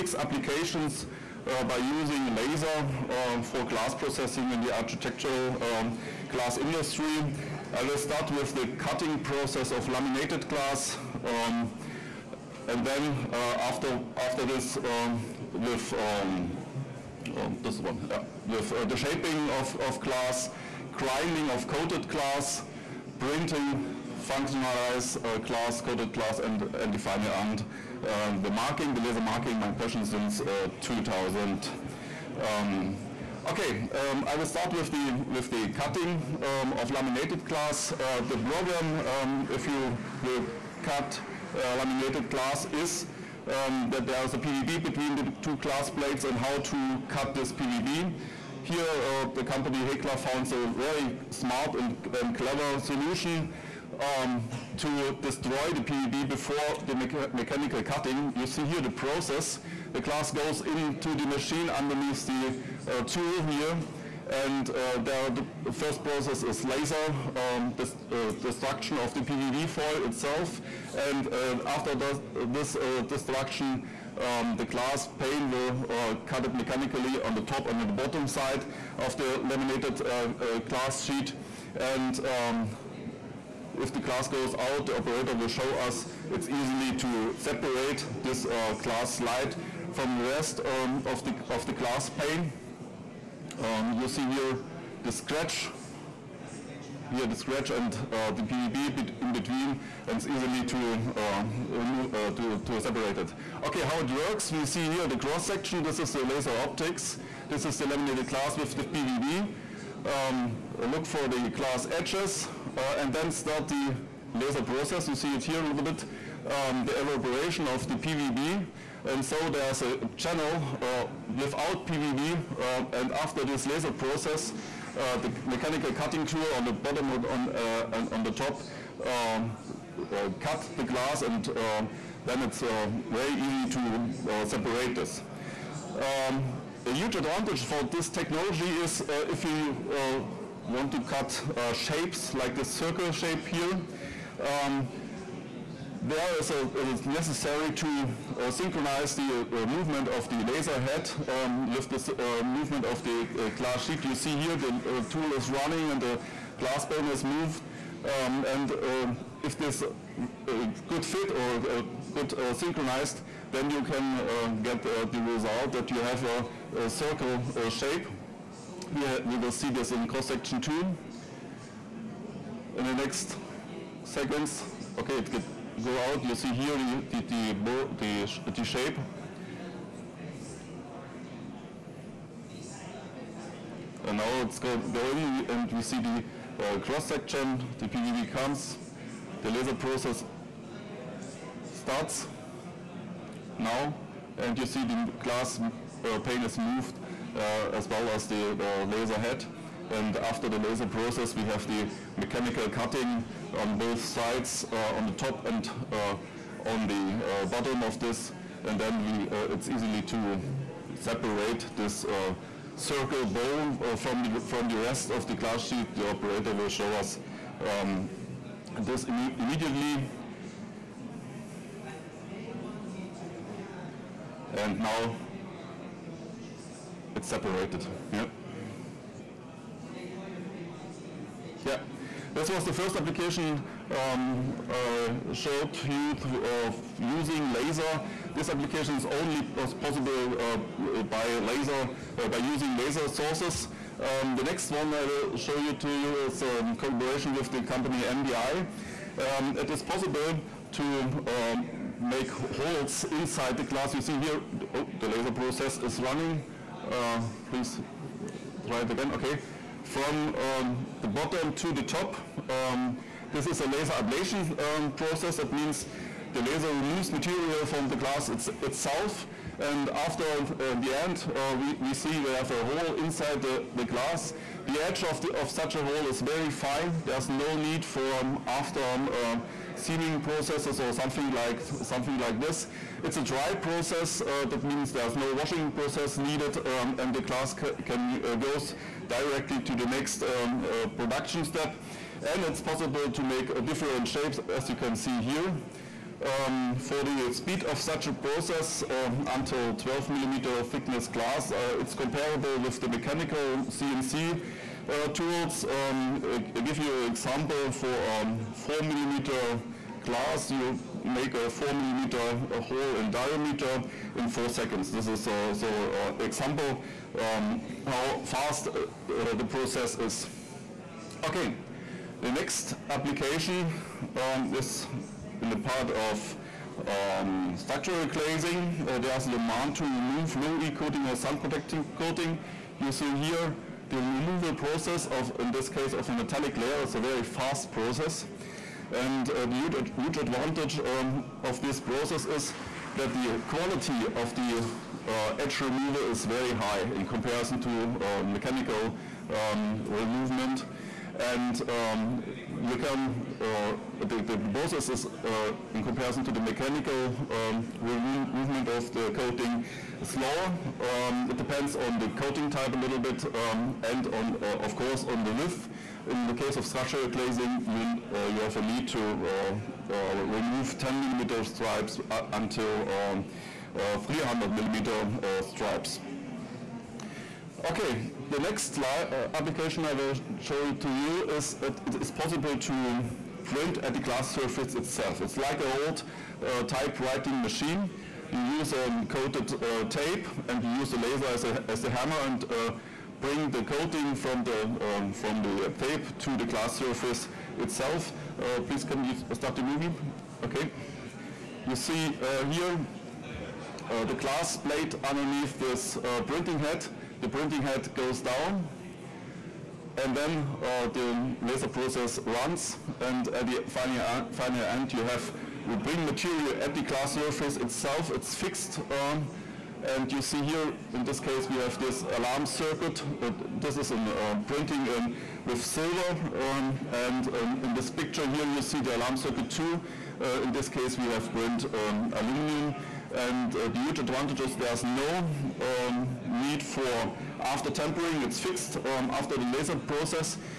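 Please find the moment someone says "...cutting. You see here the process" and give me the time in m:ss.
0:57.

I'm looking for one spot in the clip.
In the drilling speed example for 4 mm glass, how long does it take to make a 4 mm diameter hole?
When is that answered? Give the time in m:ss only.
5:14.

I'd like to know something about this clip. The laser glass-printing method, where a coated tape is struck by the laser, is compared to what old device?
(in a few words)
typewriting machine.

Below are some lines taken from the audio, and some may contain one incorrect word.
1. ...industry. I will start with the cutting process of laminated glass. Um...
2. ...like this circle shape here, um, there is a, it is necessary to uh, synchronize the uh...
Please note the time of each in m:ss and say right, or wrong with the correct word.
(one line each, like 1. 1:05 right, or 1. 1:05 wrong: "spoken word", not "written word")
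1. 0:06 right
2. 2:22 right.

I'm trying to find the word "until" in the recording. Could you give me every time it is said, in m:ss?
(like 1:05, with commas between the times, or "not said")
4:59, 6:12.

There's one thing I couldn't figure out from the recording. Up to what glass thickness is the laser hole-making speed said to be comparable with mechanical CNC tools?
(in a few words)
12 millimeter.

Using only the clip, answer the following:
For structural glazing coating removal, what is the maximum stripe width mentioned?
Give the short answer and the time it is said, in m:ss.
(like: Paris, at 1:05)
300 millimeter, at 6:14.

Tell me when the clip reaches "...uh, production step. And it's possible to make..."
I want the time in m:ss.
4:50.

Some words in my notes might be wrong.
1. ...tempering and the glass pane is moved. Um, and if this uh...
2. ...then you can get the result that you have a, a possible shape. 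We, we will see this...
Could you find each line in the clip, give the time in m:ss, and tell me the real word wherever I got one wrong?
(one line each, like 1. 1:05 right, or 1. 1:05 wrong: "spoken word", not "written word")
1. 2:35 wrong: "running", not "tempering"
2. 2:43 wrong: "circle", not "possible".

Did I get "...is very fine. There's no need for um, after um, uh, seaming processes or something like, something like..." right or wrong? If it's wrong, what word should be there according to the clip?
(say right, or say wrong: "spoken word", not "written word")
right.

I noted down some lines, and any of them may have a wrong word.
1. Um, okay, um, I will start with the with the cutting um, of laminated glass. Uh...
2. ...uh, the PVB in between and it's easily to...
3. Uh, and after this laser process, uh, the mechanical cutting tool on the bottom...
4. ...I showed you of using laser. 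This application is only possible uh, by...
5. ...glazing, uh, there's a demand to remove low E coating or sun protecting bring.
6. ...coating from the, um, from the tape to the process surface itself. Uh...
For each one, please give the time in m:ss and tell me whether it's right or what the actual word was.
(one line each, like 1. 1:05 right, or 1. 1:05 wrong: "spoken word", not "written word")
1. 0:32 right
2. 1:38 right
3. 2:02 right
4. 3:54 right
5. 5:28 wrong: "coating", not "bring"
6. 6:33 wrong: "glass", not "process".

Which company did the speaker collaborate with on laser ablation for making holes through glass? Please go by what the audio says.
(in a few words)
MDI.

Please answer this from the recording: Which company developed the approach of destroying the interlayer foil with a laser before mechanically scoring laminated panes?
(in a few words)
Hegla.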